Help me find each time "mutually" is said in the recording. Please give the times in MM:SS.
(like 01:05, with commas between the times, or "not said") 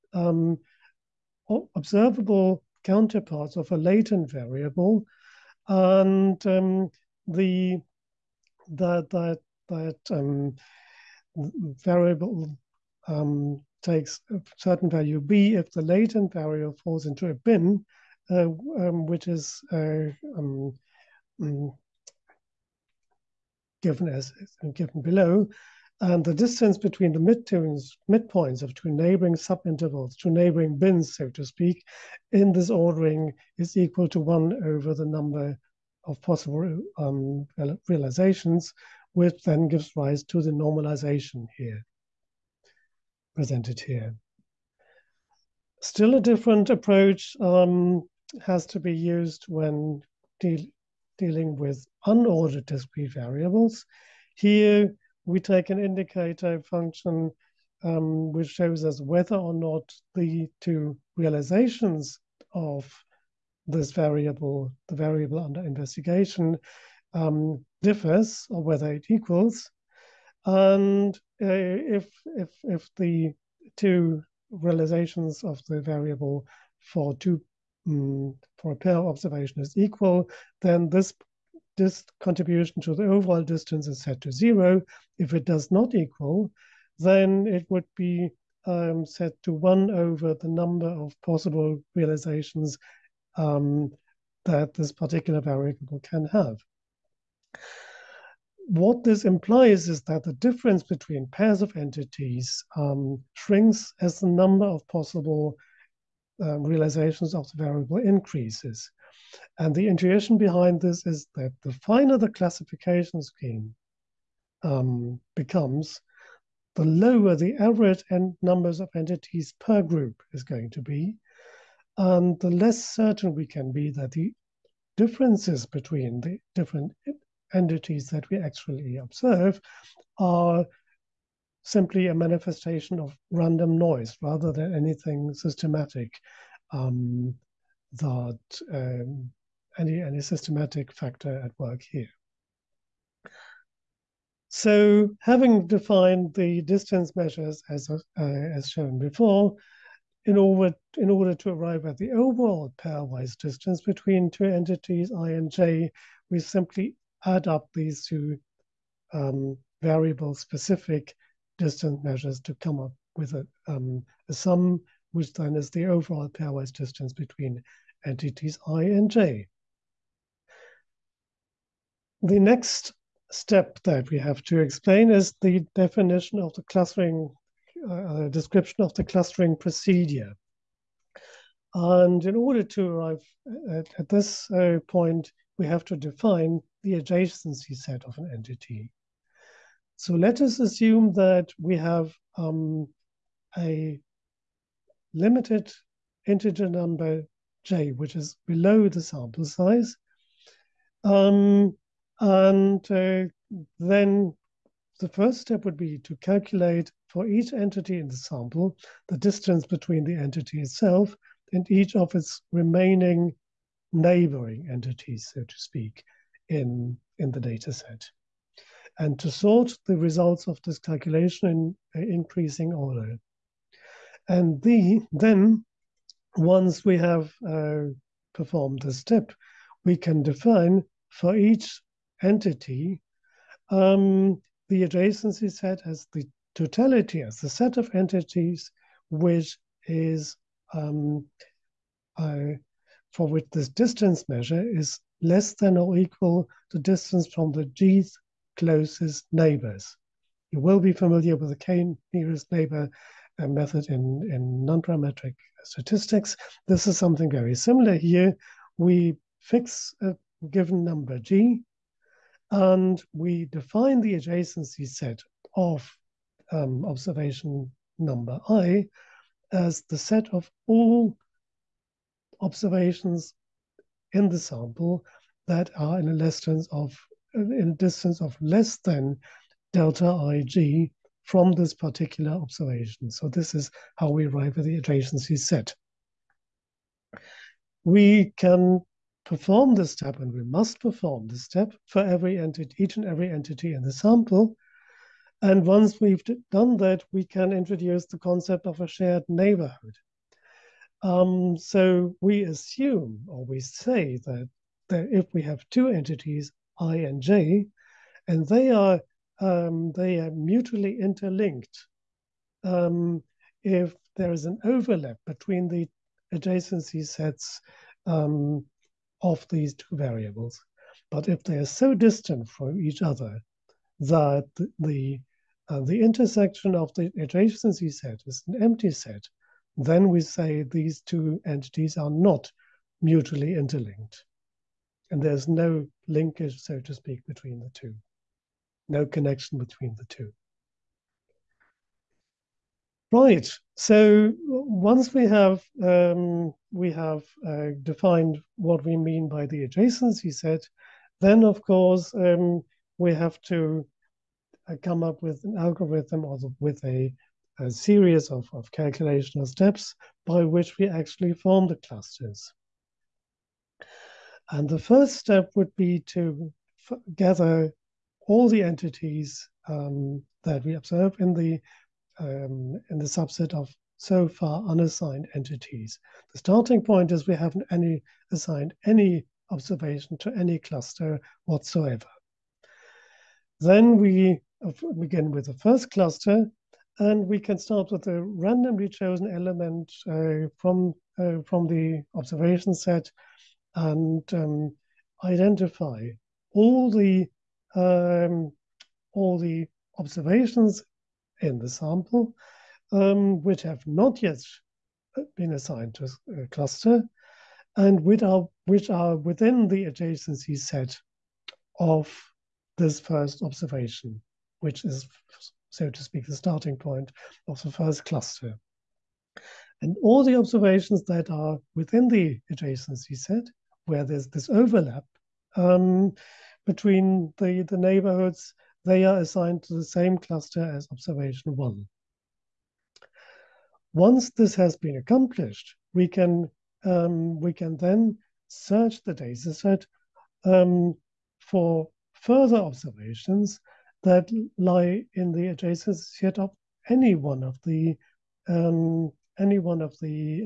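05:10, 05:33.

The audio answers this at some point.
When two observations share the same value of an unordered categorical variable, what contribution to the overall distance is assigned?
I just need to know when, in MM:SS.
01:24.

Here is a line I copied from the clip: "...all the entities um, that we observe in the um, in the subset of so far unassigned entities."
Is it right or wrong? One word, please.
right.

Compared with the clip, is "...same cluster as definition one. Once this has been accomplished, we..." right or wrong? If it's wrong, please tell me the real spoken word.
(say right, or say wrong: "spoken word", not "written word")
wrong: "observation", not "definition".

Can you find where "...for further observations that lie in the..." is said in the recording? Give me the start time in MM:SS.
07:21.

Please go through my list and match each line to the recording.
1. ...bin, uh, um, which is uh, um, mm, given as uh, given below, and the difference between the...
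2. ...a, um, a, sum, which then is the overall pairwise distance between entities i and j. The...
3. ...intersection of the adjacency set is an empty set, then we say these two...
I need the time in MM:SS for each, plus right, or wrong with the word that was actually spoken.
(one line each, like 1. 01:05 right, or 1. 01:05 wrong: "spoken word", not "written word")
1. 00:17 wrong: "distance", not "difference"
2. 02:43 right
3. 05:26 right.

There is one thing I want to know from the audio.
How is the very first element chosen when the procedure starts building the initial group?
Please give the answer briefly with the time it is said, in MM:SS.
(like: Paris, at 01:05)
Randomly, at 06:28.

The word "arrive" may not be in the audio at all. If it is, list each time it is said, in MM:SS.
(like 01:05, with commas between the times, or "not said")
02:31, 03:02, 04:44.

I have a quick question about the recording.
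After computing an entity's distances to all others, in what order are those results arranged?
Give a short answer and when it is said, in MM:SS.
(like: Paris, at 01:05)
Increasing order, at 03:42.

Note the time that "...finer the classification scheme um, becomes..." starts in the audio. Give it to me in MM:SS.
01:51.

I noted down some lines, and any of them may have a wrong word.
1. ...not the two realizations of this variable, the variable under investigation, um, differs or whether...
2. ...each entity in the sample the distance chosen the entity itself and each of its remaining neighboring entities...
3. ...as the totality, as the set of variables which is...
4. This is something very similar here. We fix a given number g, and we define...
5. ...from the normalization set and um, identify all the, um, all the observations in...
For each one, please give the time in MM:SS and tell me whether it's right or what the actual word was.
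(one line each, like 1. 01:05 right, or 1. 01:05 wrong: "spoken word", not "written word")
1. 00:59 right
2. 03:27 wrong: "between", not "chosen"
3. 03:55 wrong: "entities", not "variables"
4. 04:16 right
5. 06:31 wrong: "observation", not "normalization".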